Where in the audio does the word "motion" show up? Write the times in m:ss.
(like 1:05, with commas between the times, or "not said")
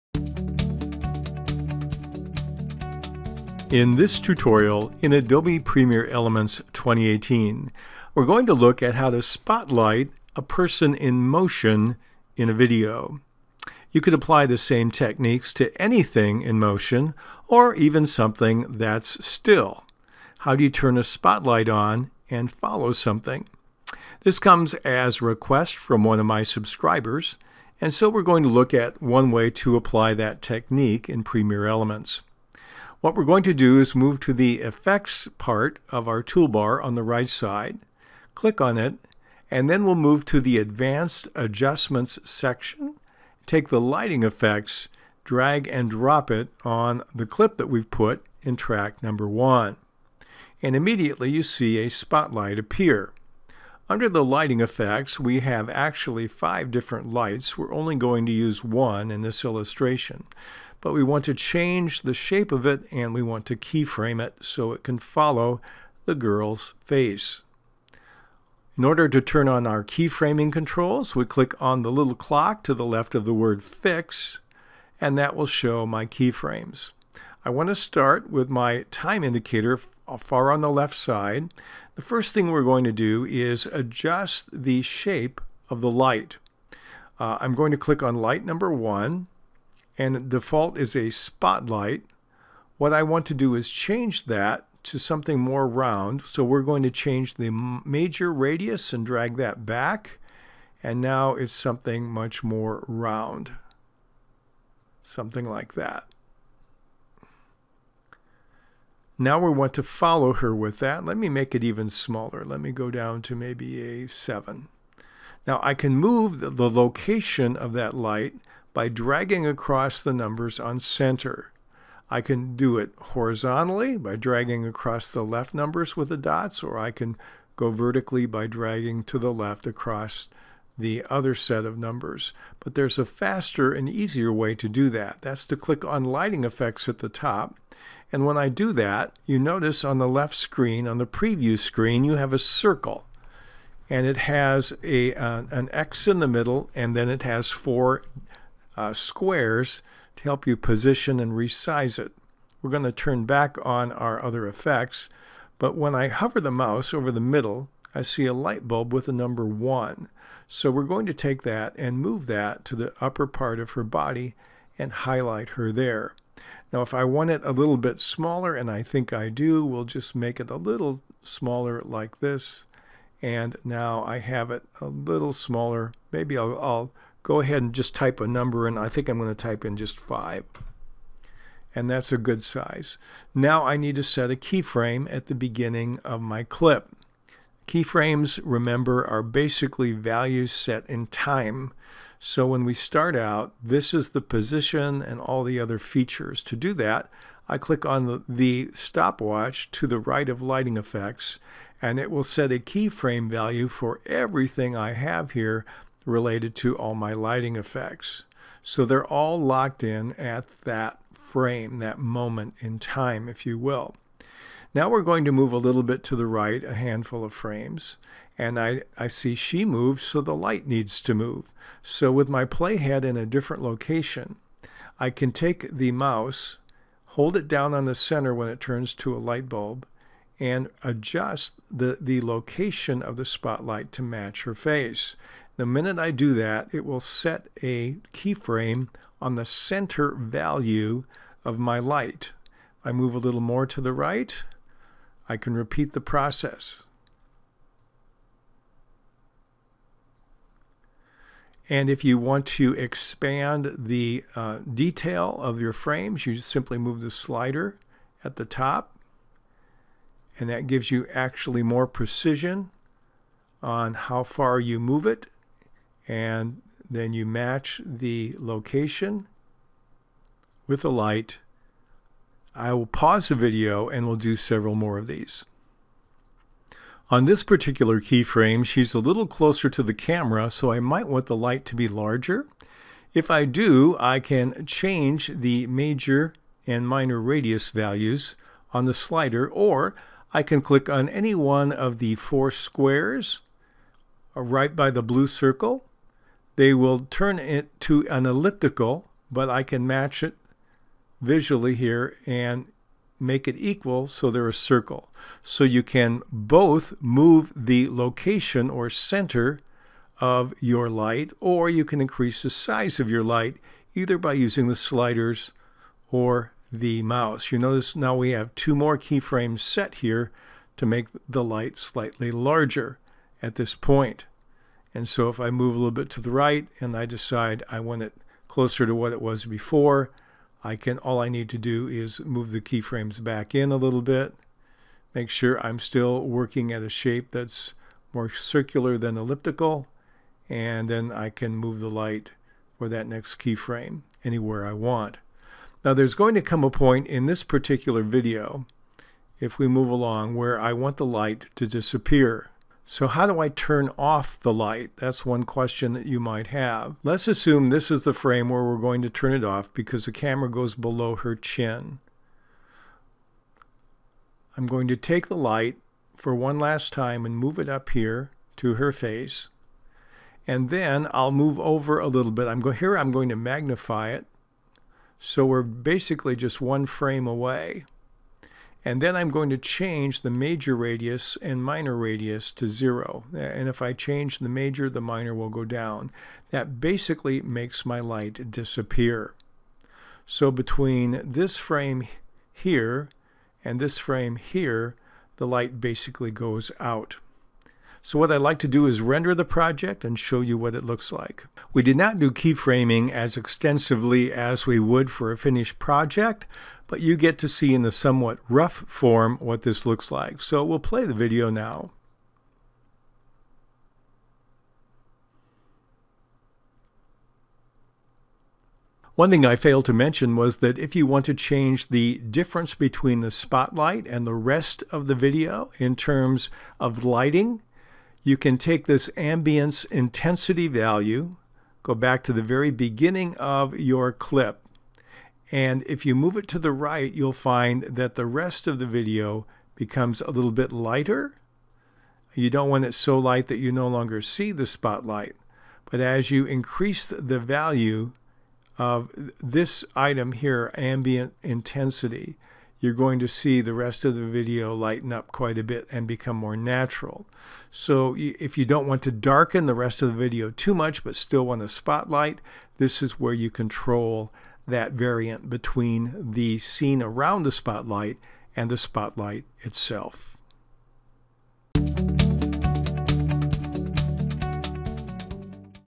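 0:11, 0:16.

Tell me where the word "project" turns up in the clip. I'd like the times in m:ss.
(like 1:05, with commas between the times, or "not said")
6:39, 6:45.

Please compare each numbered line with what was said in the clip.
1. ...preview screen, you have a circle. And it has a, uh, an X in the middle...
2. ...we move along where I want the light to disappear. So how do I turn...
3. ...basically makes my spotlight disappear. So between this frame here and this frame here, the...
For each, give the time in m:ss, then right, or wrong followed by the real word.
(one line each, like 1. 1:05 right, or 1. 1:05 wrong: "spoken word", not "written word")
1. 2:21 right
2. 5:49 right
3. 6:26 wrong: "light", not "spotlight".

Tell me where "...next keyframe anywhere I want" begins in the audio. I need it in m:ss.
5:43.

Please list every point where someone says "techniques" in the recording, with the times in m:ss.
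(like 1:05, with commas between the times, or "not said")
0:14, 0:30.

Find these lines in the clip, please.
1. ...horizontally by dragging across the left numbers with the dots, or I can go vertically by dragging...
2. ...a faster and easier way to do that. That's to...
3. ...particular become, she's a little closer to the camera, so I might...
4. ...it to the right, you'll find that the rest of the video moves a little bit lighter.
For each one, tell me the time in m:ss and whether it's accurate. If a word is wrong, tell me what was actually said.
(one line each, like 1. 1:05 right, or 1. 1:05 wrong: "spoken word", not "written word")
1. 2:02 right
2. 2:12 right
3. 4:37 wrong: "keyframe", not "become"
4. 7:16 wrong: "becomes", not "moves".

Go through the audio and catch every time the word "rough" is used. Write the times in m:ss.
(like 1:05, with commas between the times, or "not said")
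6:48.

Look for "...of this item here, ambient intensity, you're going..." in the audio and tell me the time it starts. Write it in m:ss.
7:28.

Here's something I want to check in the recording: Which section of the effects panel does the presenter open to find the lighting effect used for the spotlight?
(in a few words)
Advanced adjustments.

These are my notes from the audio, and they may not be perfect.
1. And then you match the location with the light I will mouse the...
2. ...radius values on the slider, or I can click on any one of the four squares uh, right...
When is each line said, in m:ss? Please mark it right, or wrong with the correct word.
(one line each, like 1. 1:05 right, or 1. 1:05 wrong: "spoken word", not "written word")
1. 4:26 wrong: "pause", not "mouse"
2. 4:47 right.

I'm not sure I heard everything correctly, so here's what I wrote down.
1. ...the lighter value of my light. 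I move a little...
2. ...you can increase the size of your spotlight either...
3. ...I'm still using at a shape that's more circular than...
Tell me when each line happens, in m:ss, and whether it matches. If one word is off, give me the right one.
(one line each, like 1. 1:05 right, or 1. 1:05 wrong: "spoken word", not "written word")
1. 3:59 wrong: "center", not "lighter"
2. 5:11 wrong: "light", not "spotlight"
3. 5:35 wrong: "working", not "using".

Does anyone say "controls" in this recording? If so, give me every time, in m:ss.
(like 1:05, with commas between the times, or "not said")
1:10, 7:43.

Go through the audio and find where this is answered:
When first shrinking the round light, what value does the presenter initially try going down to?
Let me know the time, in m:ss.
1:54.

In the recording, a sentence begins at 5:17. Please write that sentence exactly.
You notice now we have two more keyframes set here to make the light slightly larger at this point.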